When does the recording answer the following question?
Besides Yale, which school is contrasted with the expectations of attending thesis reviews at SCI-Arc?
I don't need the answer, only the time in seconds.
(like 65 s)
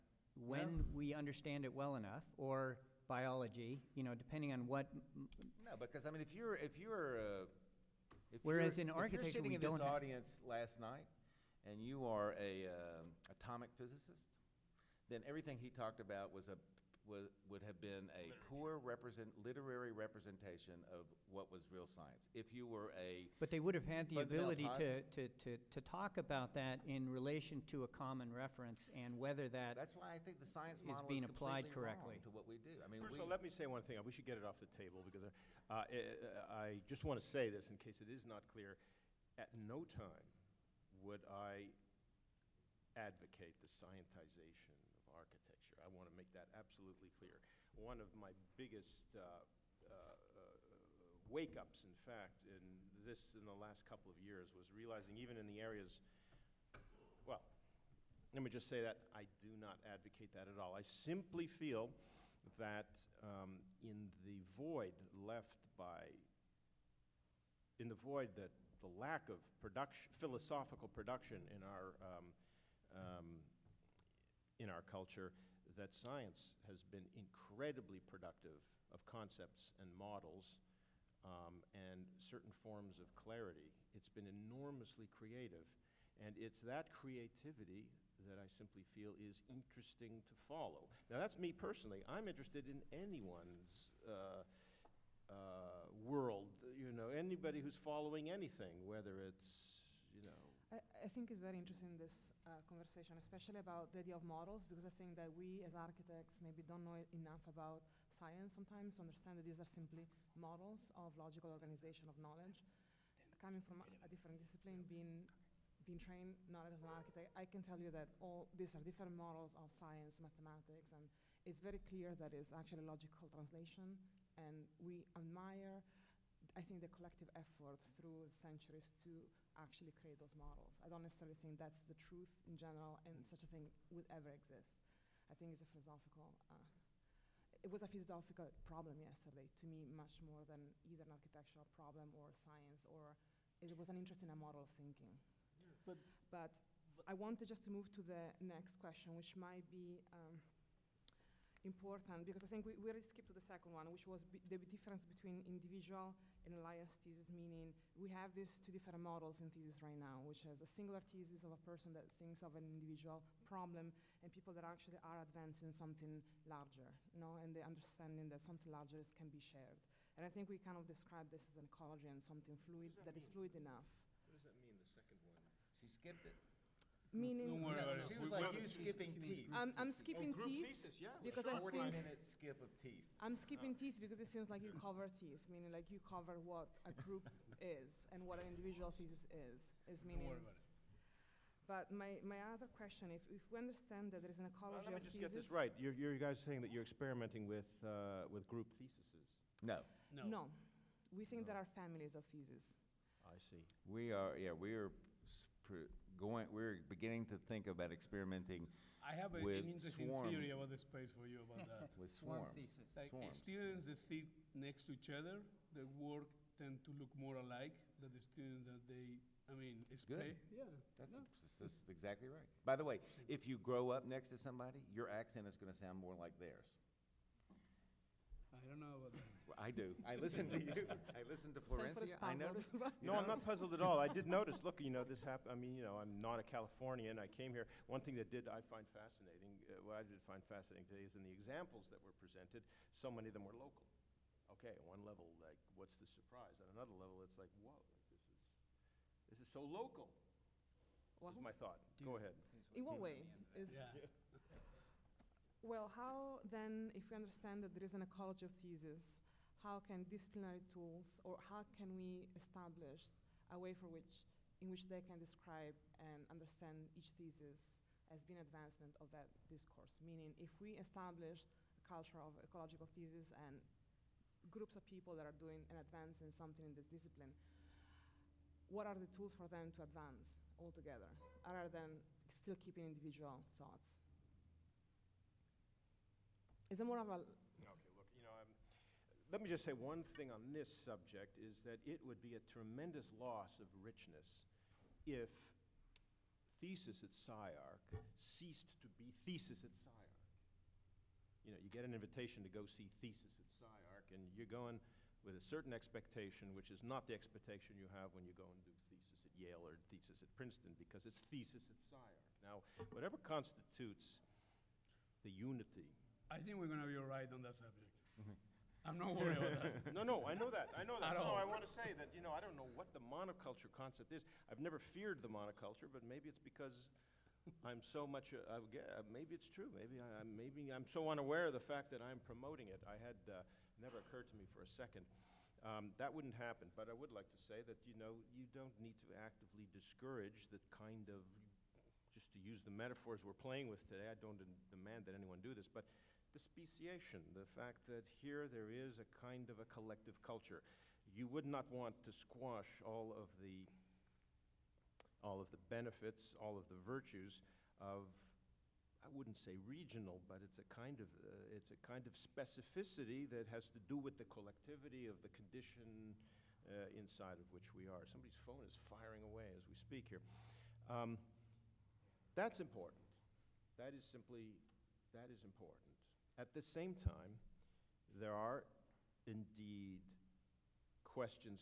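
310 s.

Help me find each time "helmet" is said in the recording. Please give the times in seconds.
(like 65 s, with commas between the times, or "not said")
not said.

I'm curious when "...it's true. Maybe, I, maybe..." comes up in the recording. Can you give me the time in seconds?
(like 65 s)
329 s.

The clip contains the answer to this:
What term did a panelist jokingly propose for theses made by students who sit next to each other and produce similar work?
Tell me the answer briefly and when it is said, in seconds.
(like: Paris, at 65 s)
swarm thesis, at 212 s.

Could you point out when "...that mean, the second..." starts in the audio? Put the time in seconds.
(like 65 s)
174 s.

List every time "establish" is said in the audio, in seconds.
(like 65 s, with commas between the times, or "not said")
262 s, 270 s.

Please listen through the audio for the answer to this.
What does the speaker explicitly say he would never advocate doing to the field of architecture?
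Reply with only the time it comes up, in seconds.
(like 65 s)
43 s.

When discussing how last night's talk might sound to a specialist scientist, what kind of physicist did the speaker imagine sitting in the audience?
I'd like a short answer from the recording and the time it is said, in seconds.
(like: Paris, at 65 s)
atomic physicist, at 13 s.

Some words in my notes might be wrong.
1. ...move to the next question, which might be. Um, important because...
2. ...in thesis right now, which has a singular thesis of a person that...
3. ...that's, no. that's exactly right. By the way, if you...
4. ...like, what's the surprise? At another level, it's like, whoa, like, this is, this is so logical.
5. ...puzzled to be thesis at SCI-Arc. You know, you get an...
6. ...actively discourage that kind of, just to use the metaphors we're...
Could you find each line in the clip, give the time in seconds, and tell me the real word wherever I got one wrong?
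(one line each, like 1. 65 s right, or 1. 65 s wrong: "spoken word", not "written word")
1. 147 s right
2. 159 s right
3. 220 s right
4. 245 s wrong: "local", not "logical"
5. 298 s wrong: "ceased", not "puzzled"
6. 339 s right.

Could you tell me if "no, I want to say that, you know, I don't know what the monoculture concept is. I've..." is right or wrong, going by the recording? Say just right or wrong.
right.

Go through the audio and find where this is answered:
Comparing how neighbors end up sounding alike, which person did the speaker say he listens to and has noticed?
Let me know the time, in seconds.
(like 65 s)
231 s.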